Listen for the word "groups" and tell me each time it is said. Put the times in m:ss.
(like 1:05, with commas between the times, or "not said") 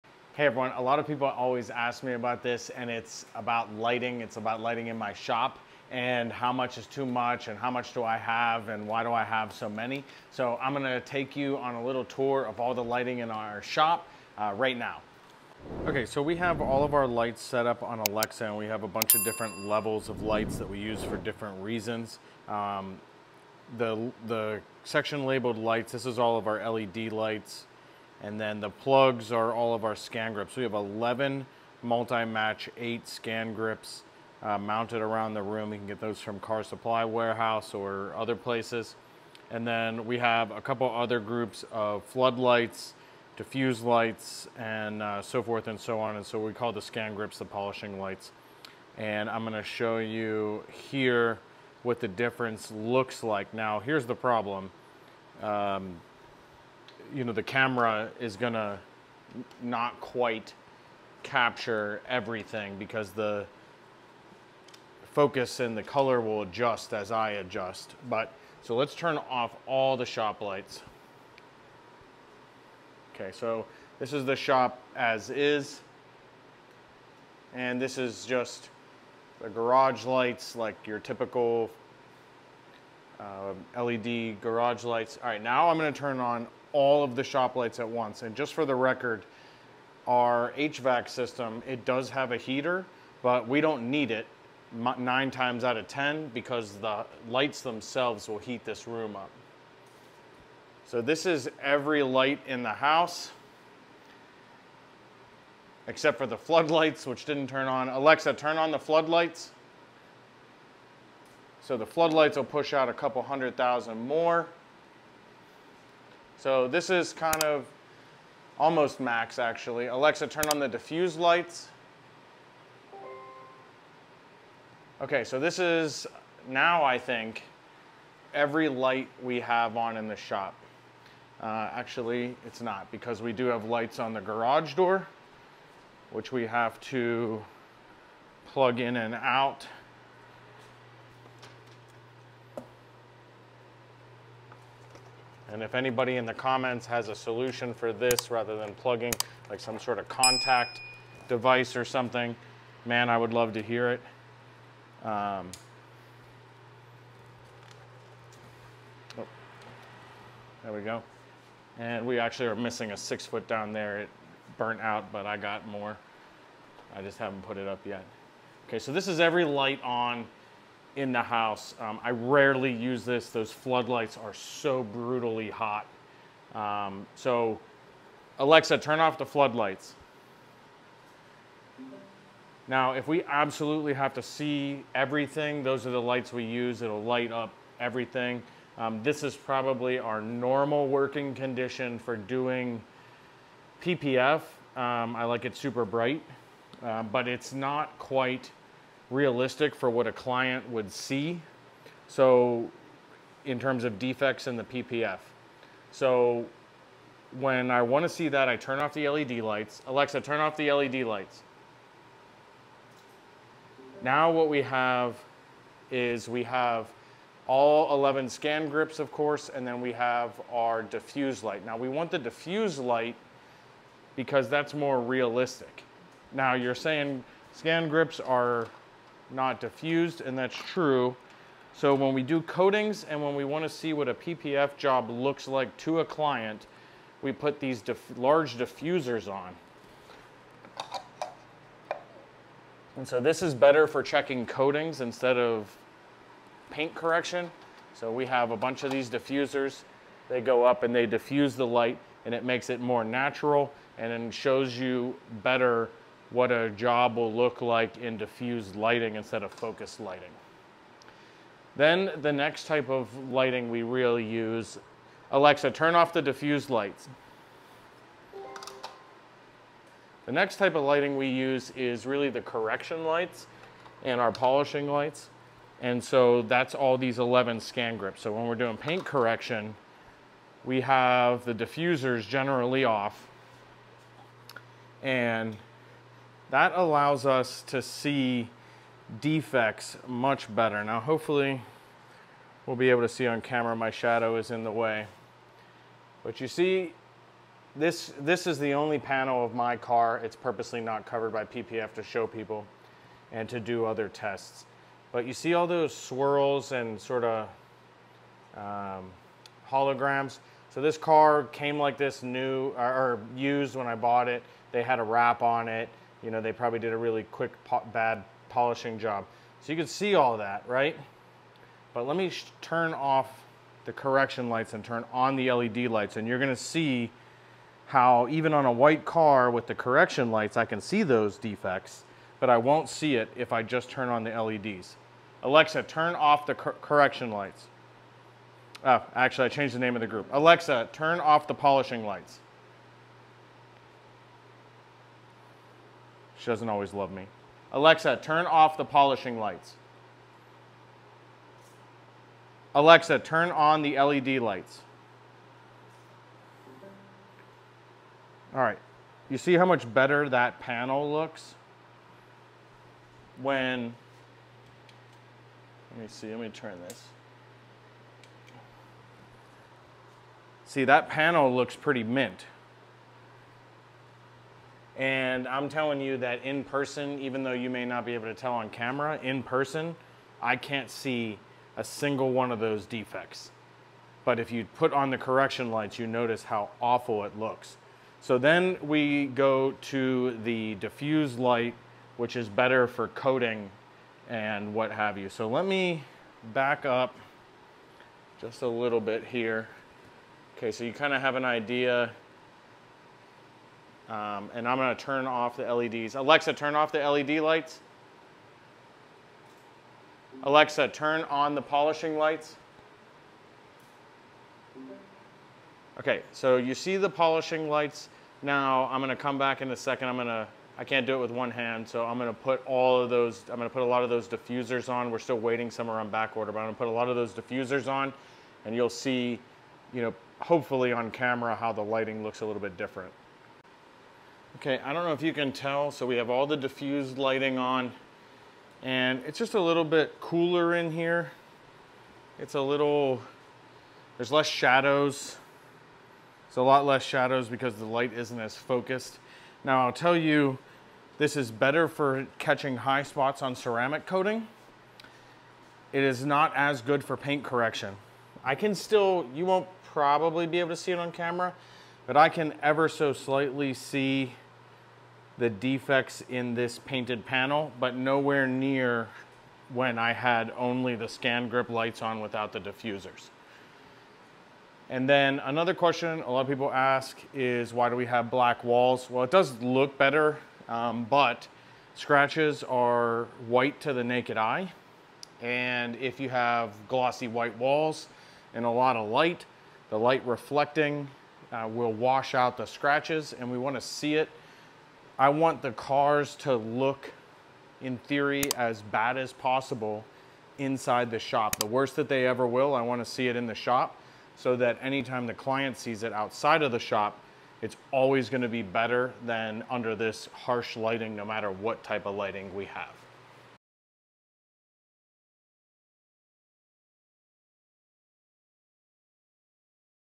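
0:41, 5:40.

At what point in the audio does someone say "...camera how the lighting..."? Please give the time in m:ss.
7:11.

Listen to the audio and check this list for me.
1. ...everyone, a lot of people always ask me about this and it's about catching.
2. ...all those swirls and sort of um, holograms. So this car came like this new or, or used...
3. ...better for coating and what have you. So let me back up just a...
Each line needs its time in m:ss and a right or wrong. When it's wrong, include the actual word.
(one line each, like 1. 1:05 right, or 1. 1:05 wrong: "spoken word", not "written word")
1. 0:00 wrong: "lighting", not "catching"
2. 5:05 right
3. 6:32 right.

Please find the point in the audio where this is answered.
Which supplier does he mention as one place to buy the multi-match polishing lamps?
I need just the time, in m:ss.
0:36.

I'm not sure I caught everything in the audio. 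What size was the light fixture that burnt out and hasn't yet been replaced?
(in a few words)
six foot.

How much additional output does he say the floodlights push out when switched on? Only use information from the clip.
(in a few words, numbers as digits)
a couple hundred thousand.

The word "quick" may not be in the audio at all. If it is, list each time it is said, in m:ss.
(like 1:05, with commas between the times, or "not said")
5:17.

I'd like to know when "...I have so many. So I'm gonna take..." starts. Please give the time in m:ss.
0:09.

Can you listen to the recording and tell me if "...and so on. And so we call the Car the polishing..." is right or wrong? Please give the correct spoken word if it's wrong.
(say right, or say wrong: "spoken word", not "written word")
wrong: "ScanGrips", not "Car".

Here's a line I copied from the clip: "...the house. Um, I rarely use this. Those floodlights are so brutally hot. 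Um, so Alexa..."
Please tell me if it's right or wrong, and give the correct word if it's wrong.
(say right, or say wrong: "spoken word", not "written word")
right.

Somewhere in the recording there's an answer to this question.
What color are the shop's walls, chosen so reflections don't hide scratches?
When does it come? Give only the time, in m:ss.
7:58.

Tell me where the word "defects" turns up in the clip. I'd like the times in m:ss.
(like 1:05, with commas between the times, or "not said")
3:23, 4:49, 5:31, 6:22, 7:45.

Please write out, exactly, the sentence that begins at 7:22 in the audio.
It's a little, there's less shadows.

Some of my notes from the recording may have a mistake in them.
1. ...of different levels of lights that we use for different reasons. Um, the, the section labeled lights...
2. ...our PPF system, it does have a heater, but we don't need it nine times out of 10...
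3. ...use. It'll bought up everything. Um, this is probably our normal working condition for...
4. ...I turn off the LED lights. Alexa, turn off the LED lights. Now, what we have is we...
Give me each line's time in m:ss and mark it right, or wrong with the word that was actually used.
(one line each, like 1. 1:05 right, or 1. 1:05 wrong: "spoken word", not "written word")
1. 0:19 right
2. 1:30 wrong: "HVAC", not "PPF"
3. 3:06 wrong: "light", not "bought"
4. 3:28 right.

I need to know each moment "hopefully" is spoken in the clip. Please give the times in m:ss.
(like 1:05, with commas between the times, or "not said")
4:50, 7:10.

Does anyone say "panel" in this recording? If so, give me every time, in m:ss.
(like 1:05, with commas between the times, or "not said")
4:58, 6:00, 6:11, 7:47.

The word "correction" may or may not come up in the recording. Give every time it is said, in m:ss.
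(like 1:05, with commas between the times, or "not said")
4:06, 4:32, 4:39, 5:23, 5:29, 5:36, 6:25, 7:37.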